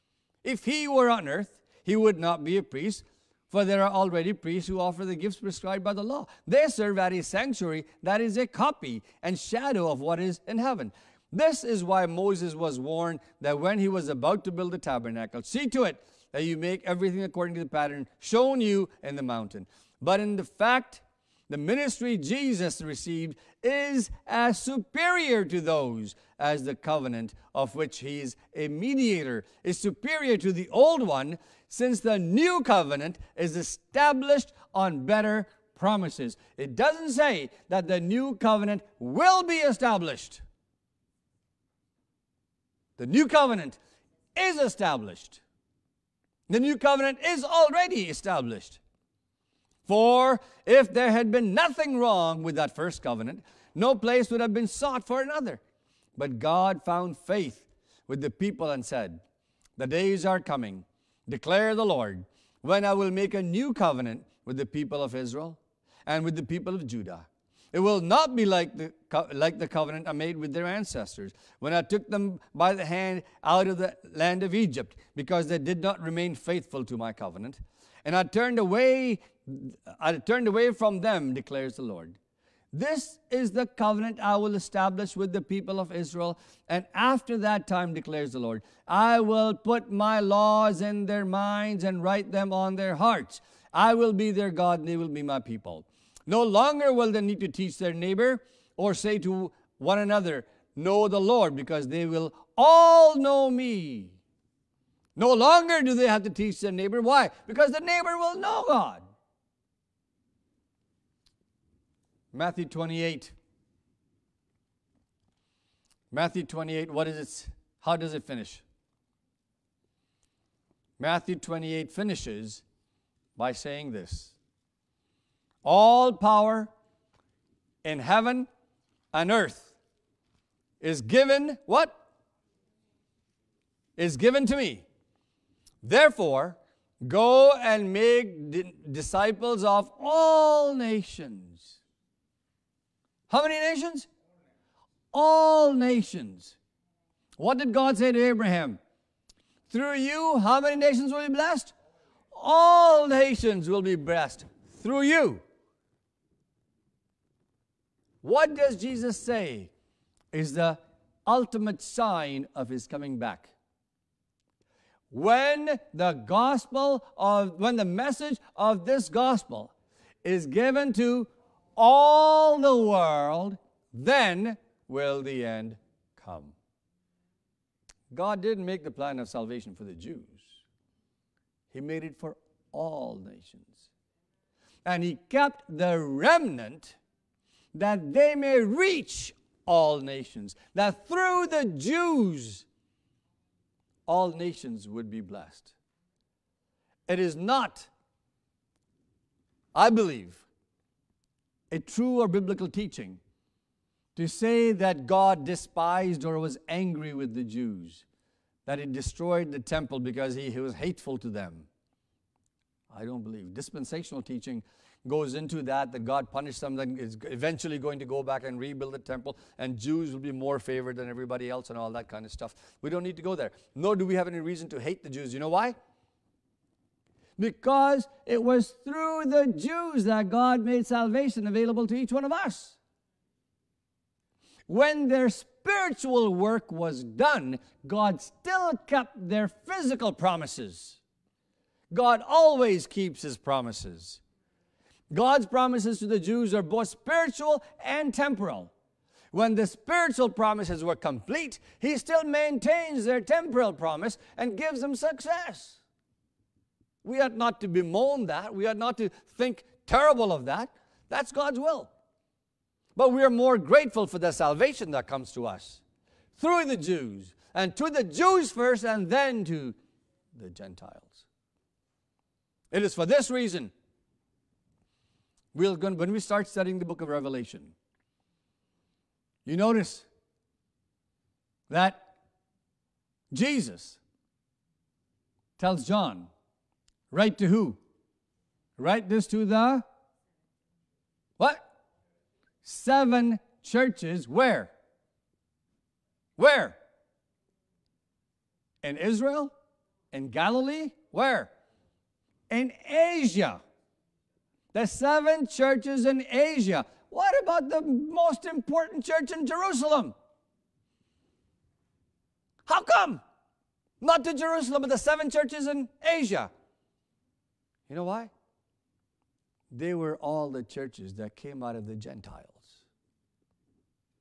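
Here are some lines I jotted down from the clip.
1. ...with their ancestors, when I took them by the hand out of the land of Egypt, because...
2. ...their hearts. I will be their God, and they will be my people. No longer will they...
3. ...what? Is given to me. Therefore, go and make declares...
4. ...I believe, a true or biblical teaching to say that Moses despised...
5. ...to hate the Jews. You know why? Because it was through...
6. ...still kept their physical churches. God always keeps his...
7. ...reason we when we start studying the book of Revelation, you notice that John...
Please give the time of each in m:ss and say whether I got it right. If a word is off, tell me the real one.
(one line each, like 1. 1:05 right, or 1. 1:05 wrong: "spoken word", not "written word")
1. 1:10 right
2. 1:32 right
3. 2:11 wrong: "disciples", not "declares"
4. 3:19 wrong: "God", not "Moses"
5. 3:44 right
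6. 3:58 wrong: "promises", not "churches"
7. 4:33 wrong: "Jesus", not "John".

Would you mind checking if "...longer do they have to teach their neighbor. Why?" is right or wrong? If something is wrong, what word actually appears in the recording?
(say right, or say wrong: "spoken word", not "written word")
right.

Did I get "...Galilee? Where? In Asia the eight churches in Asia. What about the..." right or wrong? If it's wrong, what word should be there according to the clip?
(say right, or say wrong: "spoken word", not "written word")
wrong: "seven", not "eight".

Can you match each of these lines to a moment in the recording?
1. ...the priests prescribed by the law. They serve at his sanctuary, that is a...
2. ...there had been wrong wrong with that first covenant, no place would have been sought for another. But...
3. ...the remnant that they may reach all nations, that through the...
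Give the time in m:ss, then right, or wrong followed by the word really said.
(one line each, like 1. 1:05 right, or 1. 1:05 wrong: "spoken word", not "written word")
1. 0:05 wrong: "gifts", not "priests"
2. 0:50 wrong: "nothing", not "wrong"
3. 3:05 right.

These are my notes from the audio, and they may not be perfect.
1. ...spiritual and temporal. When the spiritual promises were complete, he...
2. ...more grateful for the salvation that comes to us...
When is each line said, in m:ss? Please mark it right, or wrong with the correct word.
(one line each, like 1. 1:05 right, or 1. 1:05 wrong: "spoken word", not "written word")
1. 4:06 right
2. 4:23 right.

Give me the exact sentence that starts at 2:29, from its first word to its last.
Through you, how many nations will be blessed?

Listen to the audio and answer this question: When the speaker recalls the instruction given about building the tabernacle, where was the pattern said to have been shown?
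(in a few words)
In the mountain.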